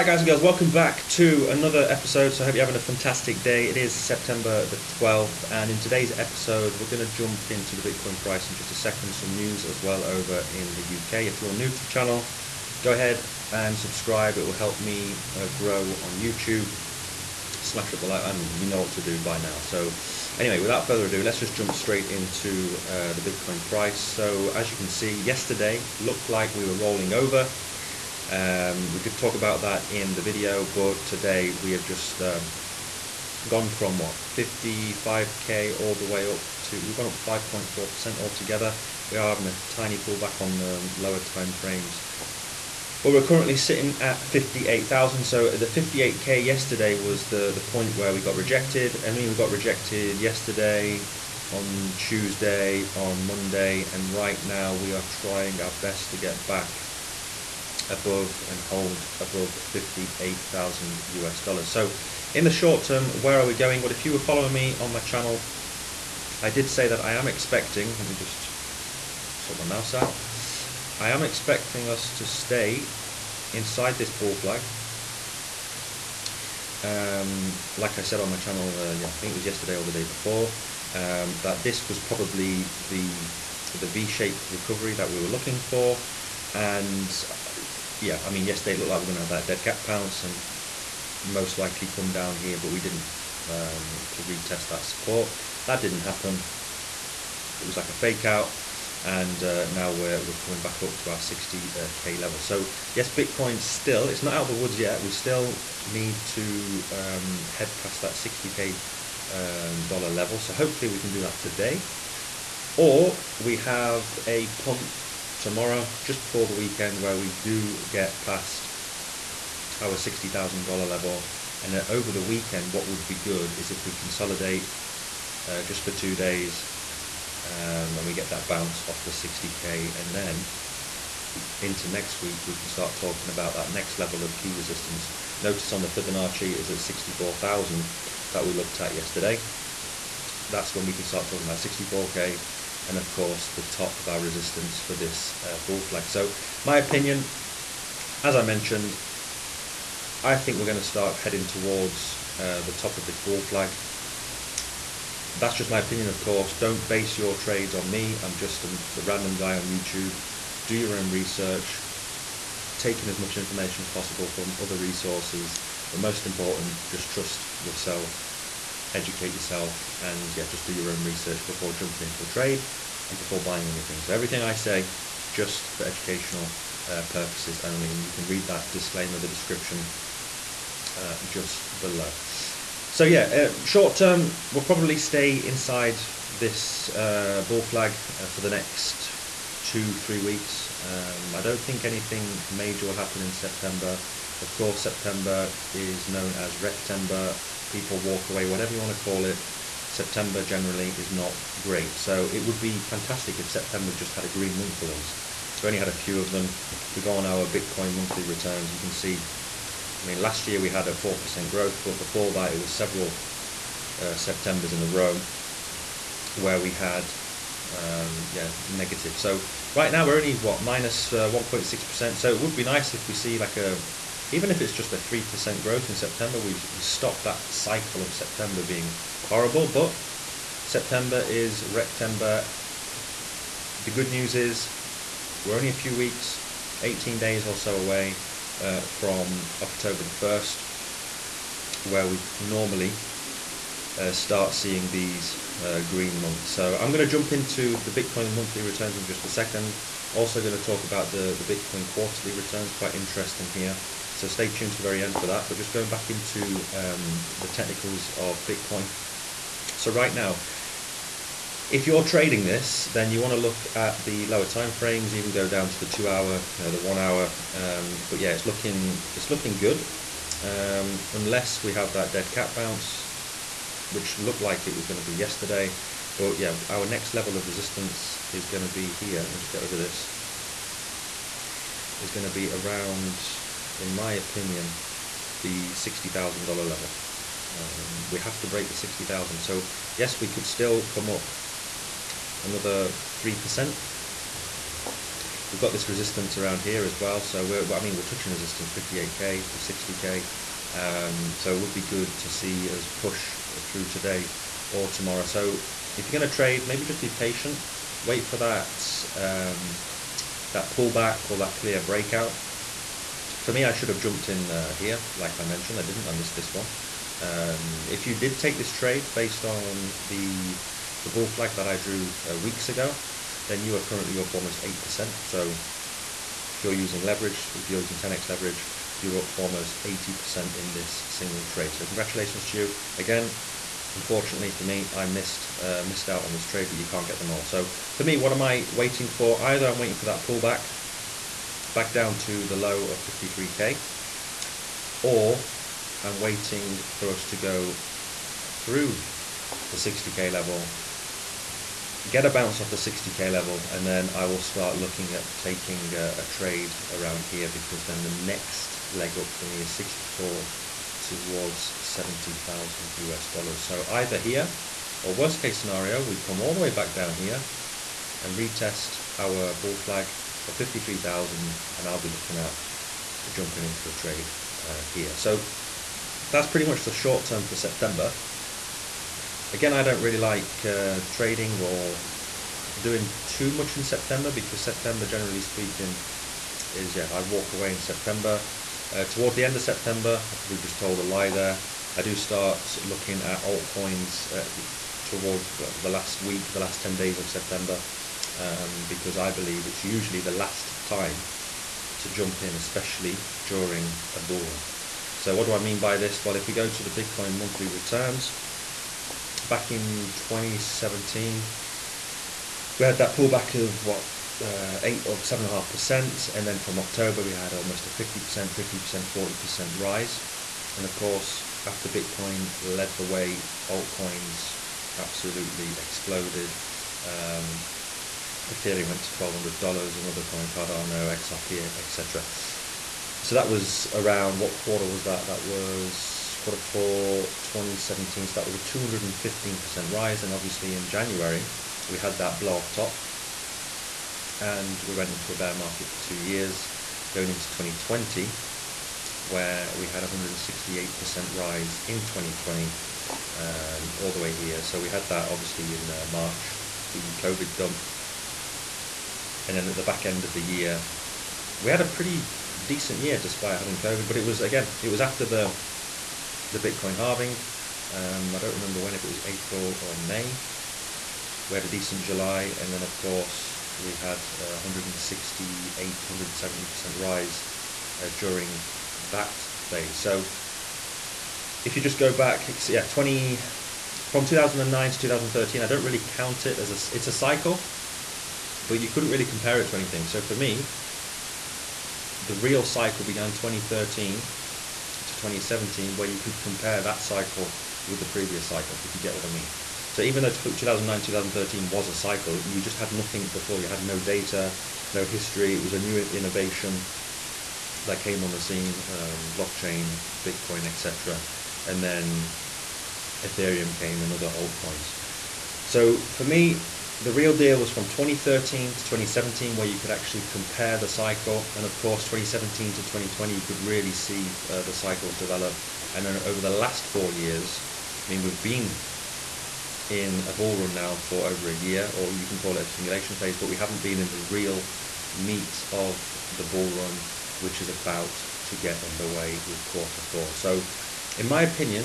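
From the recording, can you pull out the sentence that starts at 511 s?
And then Ethereum came and other altcoins.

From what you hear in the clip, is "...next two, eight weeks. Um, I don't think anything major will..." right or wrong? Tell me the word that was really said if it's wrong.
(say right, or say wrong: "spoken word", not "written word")
wrong: "three", not "eight".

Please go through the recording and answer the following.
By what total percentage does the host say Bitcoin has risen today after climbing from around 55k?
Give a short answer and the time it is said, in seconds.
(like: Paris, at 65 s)
5.4%, at 37 s.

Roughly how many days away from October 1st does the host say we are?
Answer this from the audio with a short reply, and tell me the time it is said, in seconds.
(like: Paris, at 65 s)
18, at 236 s.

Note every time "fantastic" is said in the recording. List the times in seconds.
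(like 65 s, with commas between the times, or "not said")
2 s, 202 s.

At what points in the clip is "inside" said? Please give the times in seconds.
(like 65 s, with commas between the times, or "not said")
73 s, 185 s.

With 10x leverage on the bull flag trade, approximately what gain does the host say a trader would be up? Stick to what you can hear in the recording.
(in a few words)
80%.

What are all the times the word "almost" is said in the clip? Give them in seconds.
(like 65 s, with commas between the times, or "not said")
324 s, 329 s, 417 s.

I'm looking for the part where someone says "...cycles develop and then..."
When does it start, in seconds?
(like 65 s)
524 s.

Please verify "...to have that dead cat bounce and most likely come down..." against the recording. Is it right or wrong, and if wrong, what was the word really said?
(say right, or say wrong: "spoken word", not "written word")
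right.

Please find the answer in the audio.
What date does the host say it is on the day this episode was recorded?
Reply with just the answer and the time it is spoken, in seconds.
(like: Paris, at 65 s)
September 12th, at 3 s.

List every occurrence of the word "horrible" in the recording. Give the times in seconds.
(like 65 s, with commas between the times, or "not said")
229 s.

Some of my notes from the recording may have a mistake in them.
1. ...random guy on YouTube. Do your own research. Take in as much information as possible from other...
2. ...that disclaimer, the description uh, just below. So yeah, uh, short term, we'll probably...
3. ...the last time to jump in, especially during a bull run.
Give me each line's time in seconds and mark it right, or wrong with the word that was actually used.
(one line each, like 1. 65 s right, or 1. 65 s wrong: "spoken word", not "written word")
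1. 158 s right
2. 178 s right
3. 400 s right.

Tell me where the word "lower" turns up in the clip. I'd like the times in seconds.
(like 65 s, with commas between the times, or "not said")
40 s, 264 s.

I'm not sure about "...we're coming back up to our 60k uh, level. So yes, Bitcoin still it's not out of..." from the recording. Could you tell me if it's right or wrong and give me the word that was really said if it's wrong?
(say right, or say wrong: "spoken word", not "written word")
right.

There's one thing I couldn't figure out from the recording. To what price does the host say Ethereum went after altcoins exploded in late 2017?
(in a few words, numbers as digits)
$1,200.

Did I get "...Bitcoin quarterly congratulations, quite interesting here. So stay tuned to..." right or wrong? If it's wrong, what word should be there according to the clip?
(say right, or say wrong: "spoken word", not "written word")
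wrong: "returns", not "congratulations".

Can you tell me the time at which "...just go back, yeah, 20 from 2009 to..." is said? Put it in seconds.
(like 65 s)
481 s.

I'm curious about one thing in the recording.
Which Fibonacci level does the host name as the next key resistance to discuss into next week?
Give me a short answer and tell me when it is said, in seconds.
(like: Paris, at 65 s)
64,000, at 136 s.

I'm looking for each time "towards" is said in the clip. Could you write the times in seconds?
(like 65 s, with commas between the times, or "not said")
151 s, 360 s, 389 s, 395 s.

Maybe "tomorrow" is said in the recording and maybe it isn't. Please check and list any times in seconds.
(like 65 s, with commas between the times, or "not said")
115 s, 304 s.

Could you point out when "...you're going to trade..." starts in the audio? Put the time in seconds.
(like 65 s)
306 s.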